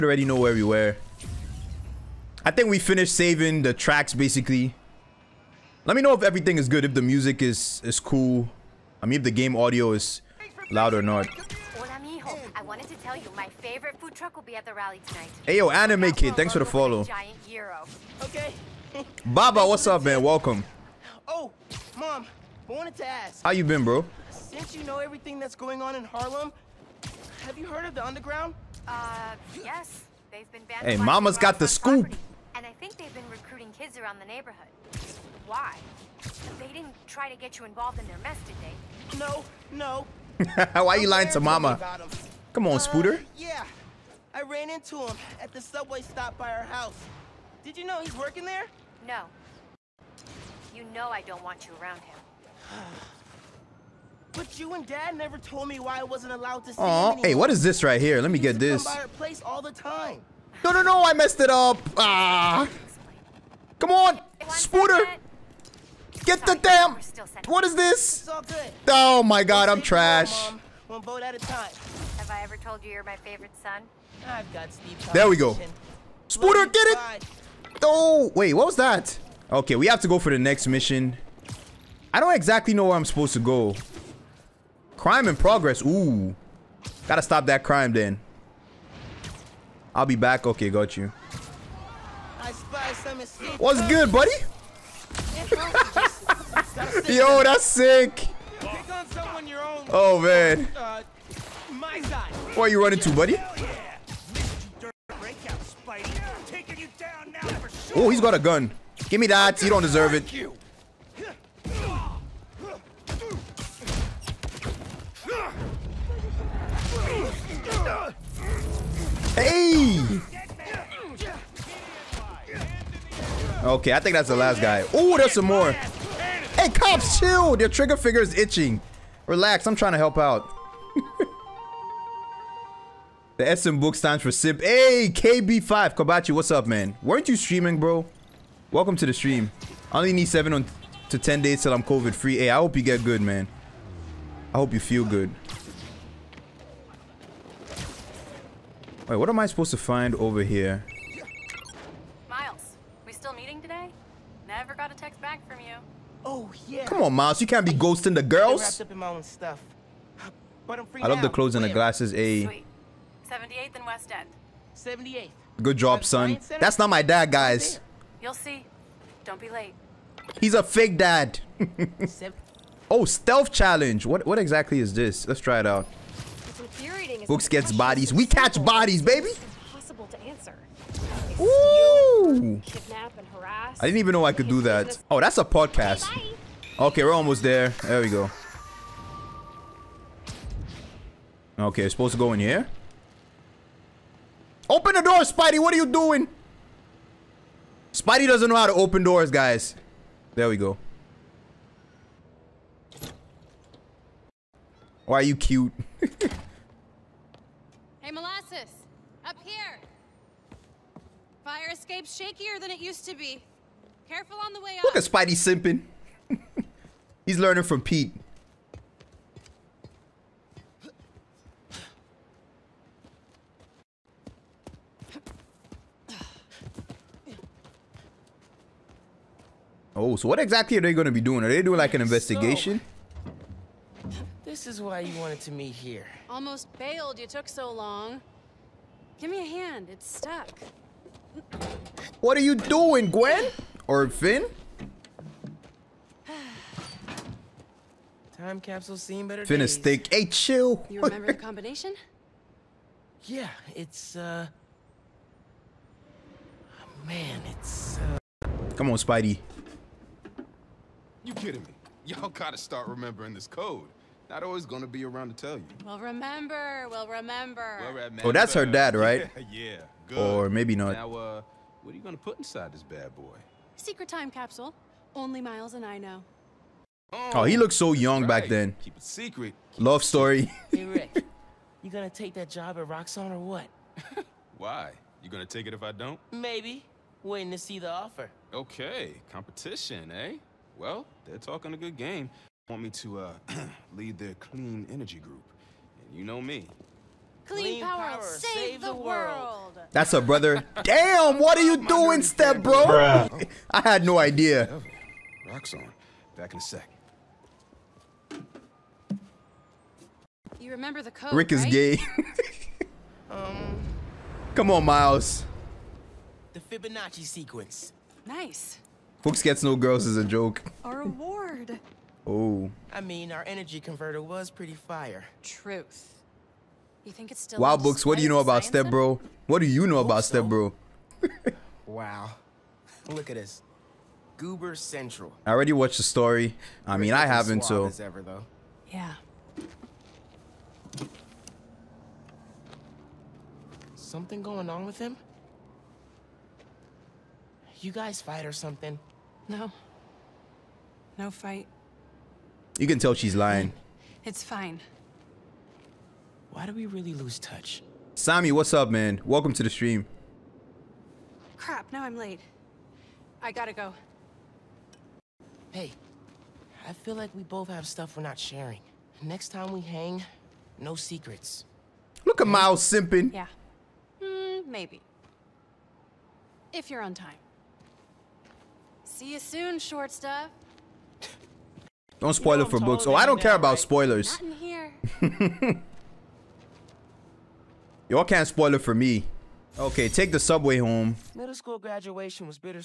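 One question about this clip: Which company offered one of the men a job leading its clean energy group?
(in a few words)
Roxxon.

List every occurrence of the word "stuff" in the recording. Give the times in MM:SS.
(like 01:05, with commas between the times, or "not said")
06:07, 06:20.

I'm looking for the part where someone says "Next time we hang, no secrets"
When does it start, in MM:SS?
06:09.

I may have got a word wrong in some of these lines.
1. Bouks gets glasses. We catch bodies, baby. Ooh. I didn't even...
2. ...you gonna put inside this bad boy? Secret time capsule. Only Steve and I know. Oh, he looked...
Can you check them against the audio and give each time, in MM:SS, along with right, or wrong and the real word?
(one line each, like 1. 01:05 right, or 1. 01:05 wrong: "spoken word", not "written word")
1. 02:57 wrong: "bodies", not "glasses"
2. 04:31 wrong: "Miles", not "Steve".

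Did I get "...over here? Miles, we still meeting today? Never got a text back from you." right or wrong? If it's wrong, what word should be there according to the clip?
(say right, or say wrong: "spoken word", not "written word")
right.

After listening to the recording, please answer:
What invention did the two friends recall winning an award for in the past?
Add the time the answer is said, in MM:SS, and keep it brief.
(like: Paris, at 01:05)
Energy converter, at 05:23.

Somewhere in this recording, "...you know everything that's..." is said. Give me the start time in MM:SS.
00:24.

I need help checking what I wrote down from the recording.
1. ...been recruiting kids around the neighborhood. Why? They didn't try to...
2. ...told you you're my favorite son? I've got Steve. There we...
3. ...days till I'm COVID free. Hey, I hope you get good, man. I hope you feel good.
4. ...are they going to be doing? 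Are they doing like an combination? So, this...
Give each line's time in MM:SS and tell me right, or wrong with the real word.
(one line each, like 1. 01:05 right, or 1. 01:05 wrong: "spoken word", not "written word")
1. 00:33 right
2. 01:12 right
3. 02:21 right
4. 03:50 wrong: "investigation", not "combination".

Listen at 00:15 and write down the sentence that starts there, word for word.
Hey yo, Anime Kid, thanks for the follow.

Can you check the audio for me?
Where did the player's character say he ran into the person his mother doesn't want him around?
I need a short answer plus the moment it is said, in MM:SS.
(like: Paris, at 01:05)
Subway stop by our house, at 00:45.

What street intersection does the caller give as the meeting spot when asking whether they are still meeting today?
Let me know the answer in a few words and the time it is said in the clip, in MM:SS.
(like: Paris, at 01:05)
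78th and West End, at 02:43.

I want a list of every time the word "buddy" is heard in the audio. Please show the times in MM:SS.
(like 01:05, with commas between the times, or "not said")
01:34, 01:43.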